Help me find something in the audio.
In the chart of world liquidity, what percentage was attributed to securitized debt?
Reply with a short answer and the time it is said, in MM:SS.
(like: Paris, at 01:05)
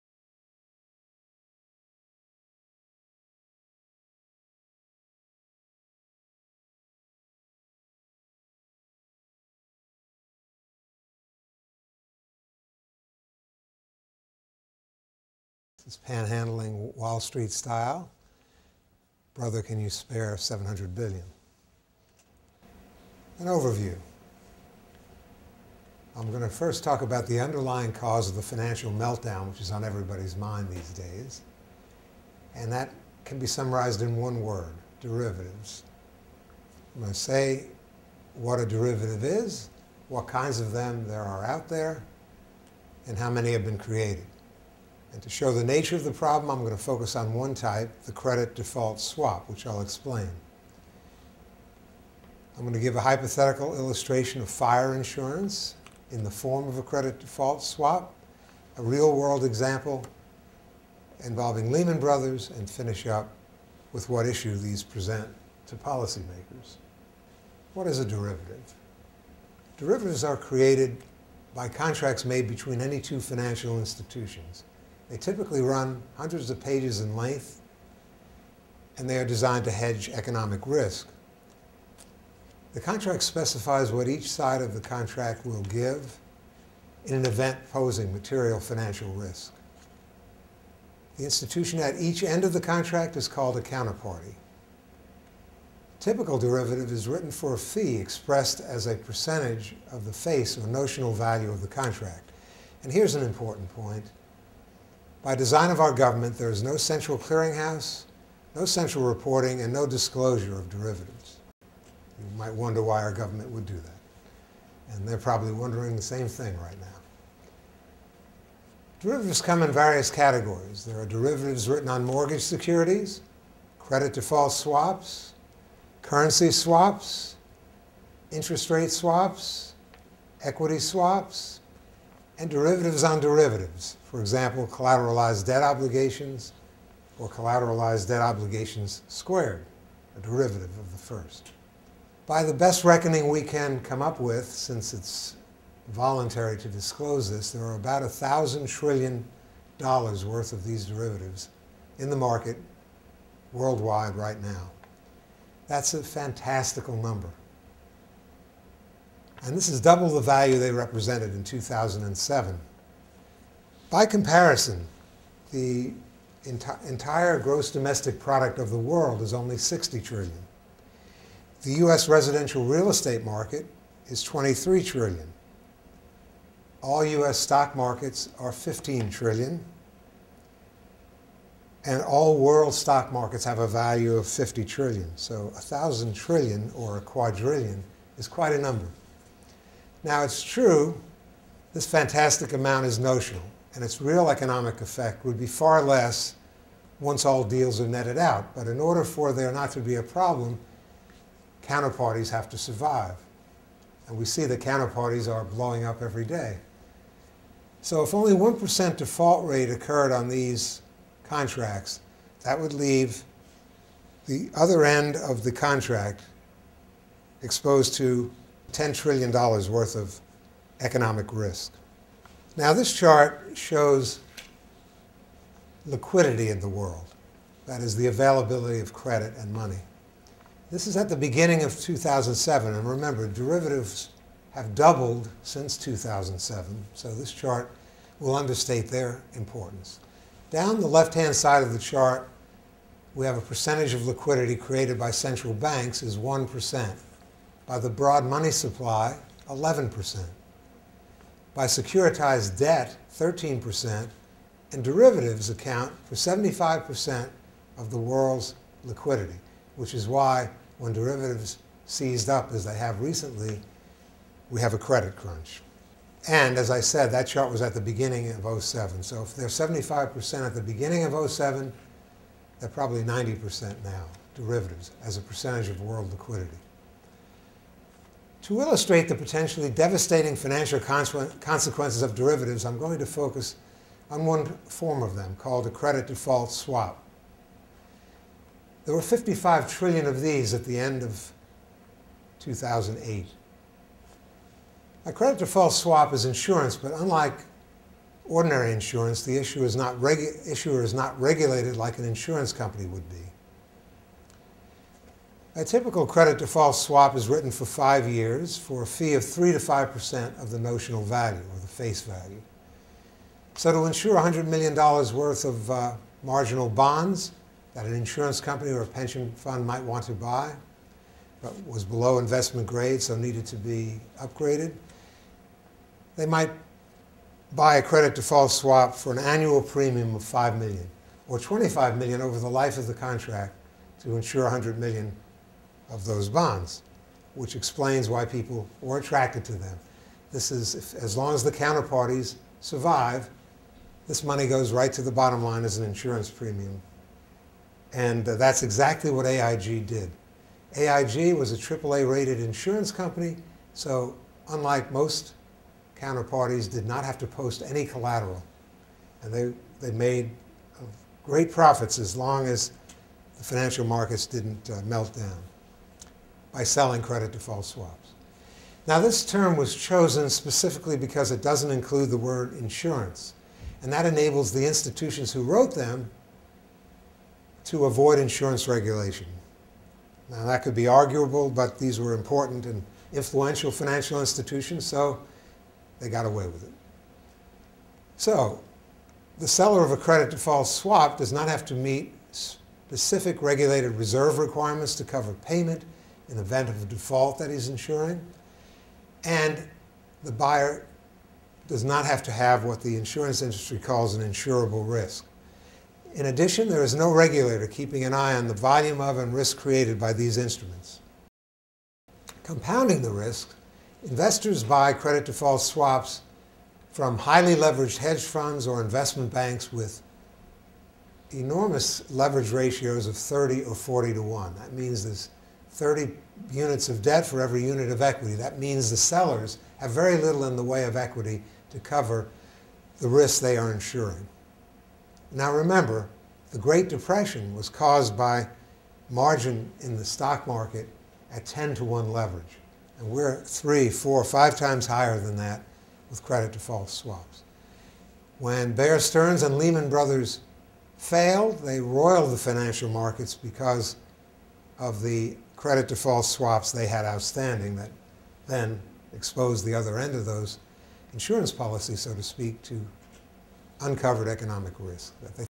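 13%, at 04:13.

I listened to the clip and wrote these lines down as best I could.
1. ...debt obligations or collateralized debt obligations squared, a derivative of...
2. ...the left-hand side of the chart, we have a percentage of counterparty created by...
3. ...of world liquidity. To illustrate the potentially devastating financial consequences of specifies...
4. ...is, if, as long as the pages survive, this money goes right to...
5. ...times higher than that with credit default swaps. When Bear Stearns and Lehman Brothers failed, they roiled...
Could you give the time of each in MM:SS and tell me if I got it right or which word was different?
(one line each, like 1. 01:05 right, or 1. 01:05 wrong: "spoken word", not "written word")
1. 02:15 right
2. 04:00 wrong: "liquidity", not "counterparty"
3. 04:35 wrong: "derivatives", not "specifies"
4. 05:40 wrong: "counterparties", not "pages"
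5. 07:24 right.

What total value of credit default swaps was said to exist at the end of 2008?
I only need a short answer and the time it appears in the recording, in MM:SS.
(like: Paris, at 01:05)
55 trillion, at 04:49.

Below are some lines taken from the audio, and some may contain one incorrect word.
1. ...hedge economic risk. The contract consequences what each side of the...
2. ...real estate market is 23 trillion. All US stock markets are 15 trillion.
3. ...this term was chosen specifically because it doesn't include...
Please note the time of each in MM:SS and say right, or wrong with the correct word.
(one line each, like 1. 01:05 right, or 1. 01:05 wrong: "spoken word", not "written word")
1. 01:19 wrong: "specifies", not "consequences"
2. 02:52 right
3. 06:08 right.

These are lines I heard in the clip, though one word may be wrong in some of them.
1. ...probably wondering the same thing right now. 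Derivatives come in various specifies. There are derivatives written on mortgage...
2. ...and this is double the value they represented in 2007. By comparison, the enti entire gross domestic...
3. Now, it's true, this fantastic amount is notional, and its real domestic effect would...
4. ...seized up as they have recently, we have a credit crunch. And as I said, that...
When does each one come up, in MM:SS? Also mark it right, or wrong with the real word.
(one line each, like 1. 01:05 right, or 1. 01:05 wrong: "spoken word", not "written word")
1. 01:55 wrong: "categories", not "specifies"
2. 02:39 right
3. 03:10 wrong: "economic", not "domestic"
4. 04:21 right.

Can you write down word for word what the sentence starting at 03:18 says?
But in order for there not to be a problem, counterparties have to survive.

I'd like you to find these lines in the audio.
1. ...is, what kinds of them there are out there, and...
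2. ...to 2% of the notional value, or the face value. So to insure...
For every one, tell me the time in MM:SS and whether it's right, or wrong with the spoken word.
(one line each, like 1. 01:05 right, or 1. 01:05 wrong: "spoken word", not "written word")
1. 00:39 right
2. 05:09 wrong: "5", not "2".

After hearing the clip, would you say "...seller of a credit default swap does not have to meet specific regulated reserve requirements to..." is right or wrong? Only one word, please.
right.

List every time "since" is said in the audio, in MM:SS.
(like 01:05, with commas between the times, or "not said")
02:24, 03:55.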